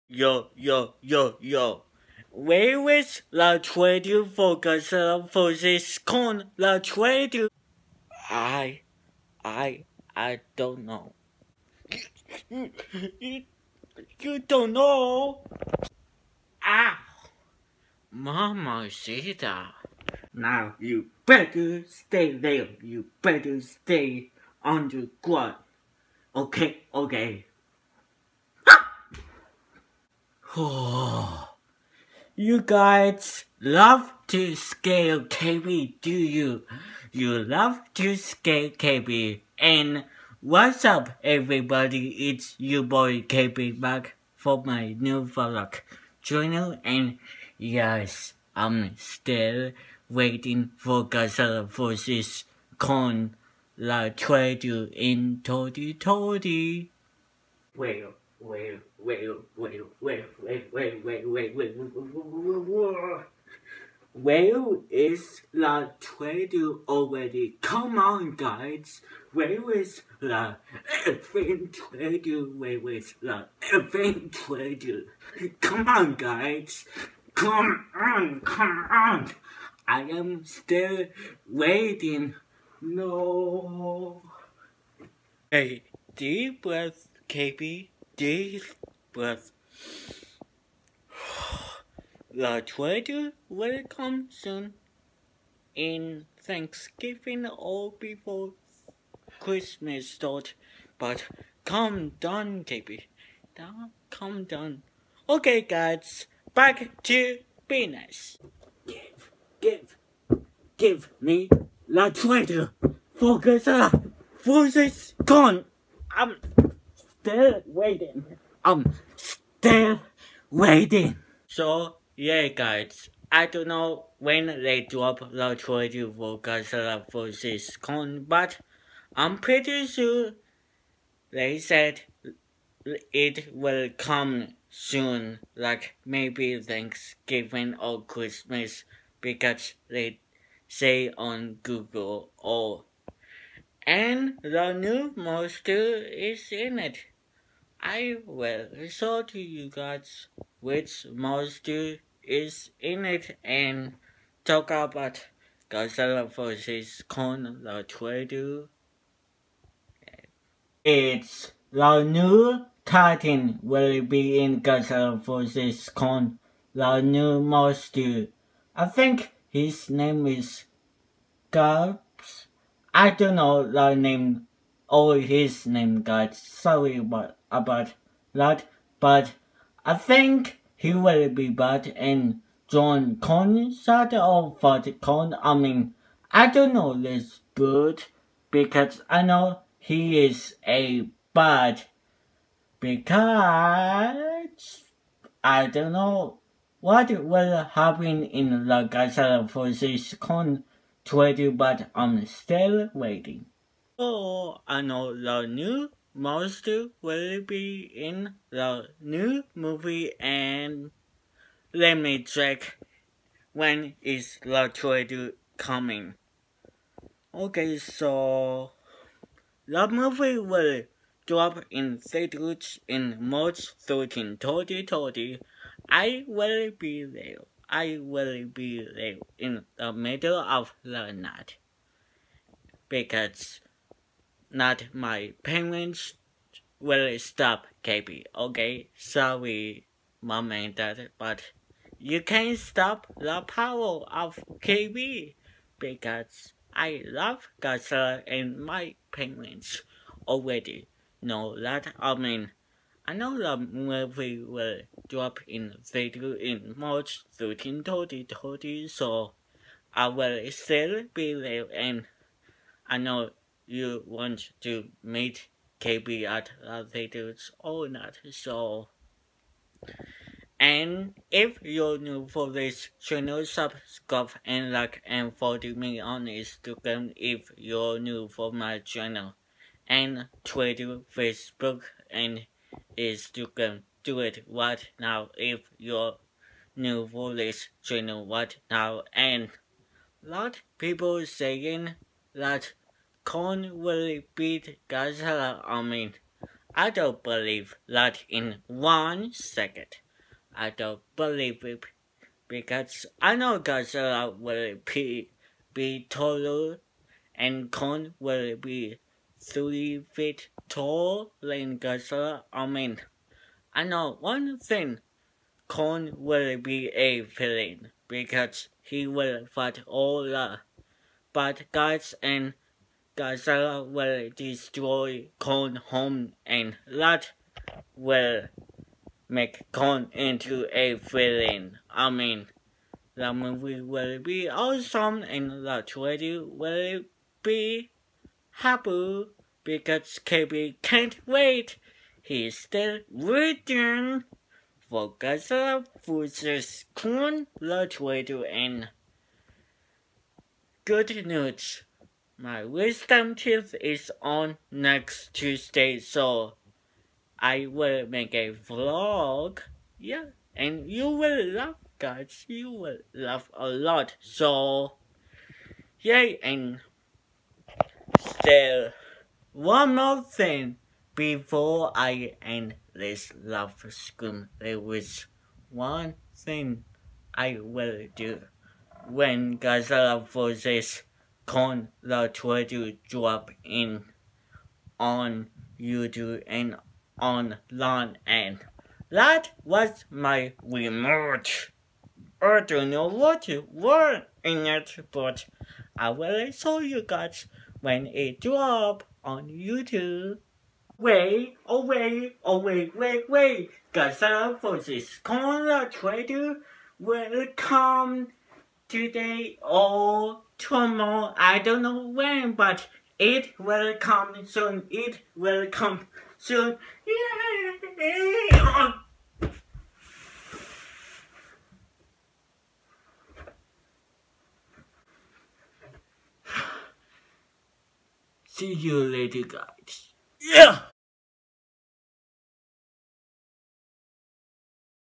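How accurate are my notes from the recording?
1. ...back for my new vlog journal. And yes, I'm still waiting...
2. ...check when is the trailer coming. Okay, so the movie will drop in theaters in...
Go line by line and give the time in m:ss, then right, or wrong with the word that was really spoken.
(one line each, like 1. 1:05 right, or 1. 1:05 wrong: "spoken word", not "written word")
1. 0:43 right
2. 3:32 right.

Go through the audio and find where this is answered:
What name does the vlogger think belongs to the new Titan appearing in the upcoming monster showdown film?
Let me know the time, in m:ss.
2:51.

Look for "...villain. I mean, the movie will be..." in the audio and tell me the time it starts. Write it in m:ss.
5:30.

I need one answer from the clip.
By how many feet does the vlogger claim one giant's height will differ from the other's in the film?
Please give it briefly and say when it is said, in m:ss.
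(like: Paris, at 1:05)
3 feet, at 5:09.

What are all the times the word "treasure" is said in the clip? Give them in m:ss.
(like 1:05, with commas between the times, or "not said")
1:32, 1:52.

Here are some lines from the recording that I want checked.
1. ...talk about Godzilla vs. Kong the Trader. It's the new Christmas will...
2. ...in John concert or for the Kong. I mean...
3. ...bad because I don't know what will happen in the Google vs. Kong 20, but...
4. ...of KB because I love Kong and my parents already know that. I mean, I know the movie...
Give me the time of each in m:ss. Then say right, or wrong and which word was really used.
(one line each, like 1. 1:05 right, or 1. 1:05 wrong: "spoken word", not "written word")
1. 2:34 wrong: "Titan", not "Christmas"
2. 3:01 right
3. 3:11 wrong: "Godzilla", not "Google"
4. 4:04 wrong: "Godzilla", not "Kong".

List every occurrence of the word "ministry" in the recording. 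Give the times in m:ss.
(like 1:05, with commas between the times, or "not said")
not said.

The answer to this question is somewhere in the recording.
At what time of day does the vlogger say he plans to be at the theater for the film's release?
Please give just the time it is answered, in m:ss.
3:49.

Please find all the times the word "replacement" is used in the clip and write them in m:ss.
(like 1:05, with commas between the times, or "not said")
not said.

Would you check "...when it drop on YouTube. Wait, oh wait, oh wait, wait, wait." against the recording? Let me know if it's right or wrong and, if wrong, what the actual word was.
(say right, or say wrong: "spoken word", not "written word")
right.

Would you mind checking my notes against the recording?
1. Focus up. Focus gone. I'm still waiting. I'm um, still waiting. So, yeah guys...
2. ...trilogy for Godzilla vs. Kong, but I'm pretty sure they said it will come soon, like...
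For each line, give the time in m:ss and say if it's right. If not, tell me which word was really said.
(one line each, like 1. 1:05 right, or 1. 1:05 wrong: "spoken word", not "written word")
1. 1:53 right
2. 2:05 right.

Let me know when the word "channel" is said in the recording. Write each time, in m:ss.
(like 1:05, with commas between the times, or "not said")
4:32, 4:38, 4:47.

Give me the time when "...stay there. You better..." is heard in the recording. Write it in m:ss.
0:21.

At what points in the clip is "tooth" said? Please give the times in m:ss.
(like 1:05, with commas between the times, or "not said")
5:53.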